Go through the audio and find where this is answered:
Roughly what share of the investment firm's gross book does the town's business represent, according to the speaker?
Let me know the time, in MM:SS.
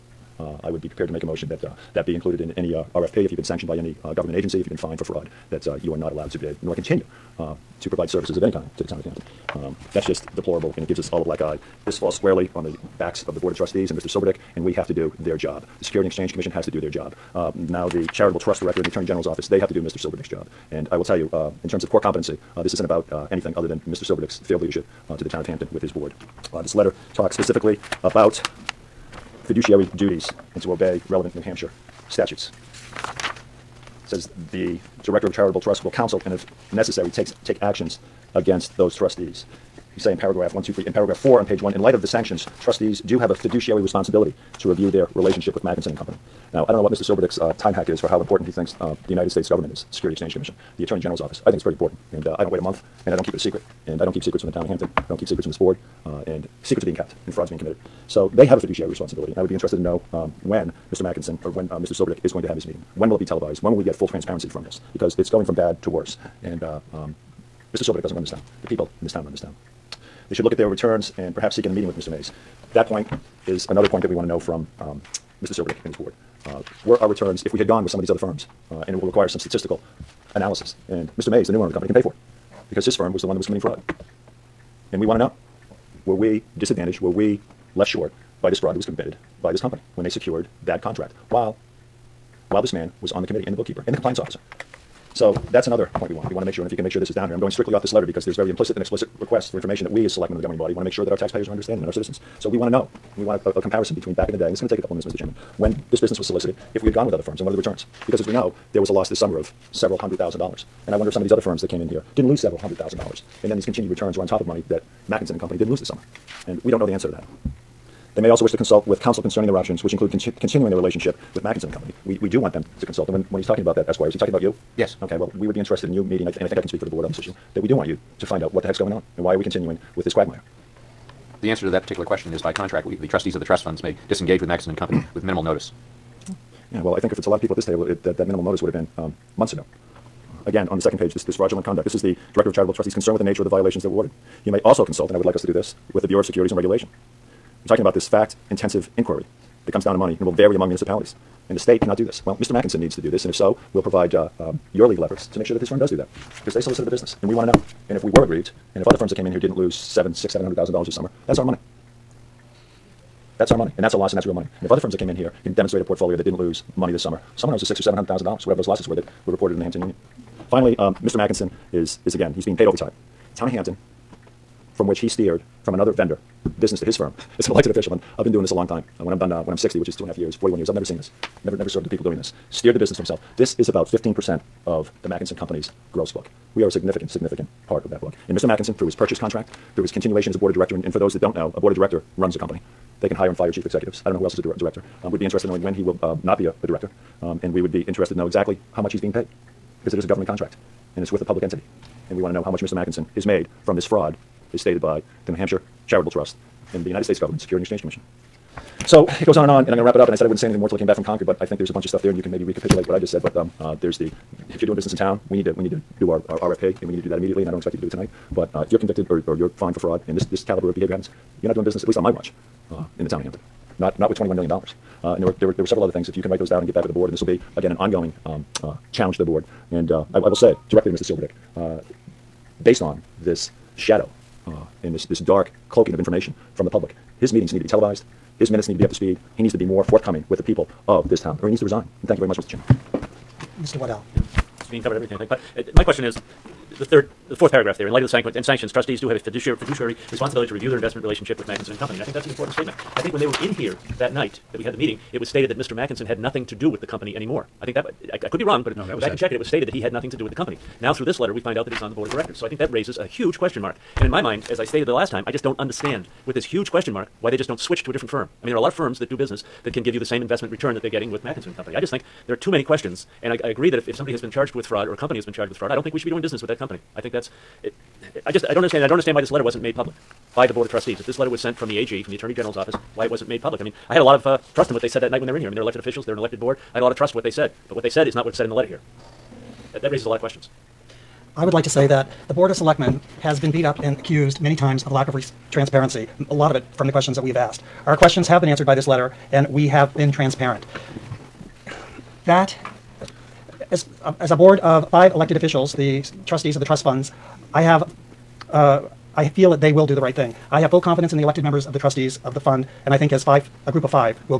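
03:03.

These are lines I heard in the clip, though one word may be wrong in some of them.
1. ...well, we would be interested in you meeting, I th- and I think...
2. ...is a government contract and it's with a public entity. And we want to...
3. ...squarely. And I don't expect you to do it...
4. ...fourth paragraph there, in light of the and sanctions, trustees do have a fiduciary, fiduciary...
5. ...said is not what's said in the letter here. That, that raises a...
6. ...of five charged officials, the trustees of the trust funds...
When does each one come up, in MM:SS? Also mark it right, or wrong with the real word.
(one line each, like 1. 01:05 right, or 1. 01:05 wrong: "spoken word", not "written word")
1. 02:05 right
2. 03:19 right
3. 03:37 wrong: "immediately", not "squarely"
4. 04:07 right
5. 04:47 right
6. 05:04 wrong: "elected", not "charged".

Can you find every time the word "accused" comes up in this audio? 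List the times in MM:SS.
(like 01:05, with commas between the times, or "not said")
04:53.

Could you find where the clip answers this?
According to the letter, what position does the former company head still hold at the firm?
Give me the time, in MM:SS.
04:21.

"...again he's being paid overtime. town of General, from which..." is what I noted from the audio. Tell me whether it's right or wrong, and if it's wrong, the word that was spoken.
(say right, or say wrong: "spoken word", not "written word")
wrong: "Hampton", not "General".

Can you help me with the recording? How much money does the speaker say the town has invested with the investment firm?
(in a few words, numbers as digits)
$21 million.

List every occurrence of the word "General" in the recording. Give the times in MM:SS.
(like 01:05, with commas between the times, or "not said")
00:19, 00:50, 04:42.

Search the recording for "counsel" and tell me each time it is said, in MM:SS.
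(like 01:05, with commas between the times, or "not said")
00:35, 01:58.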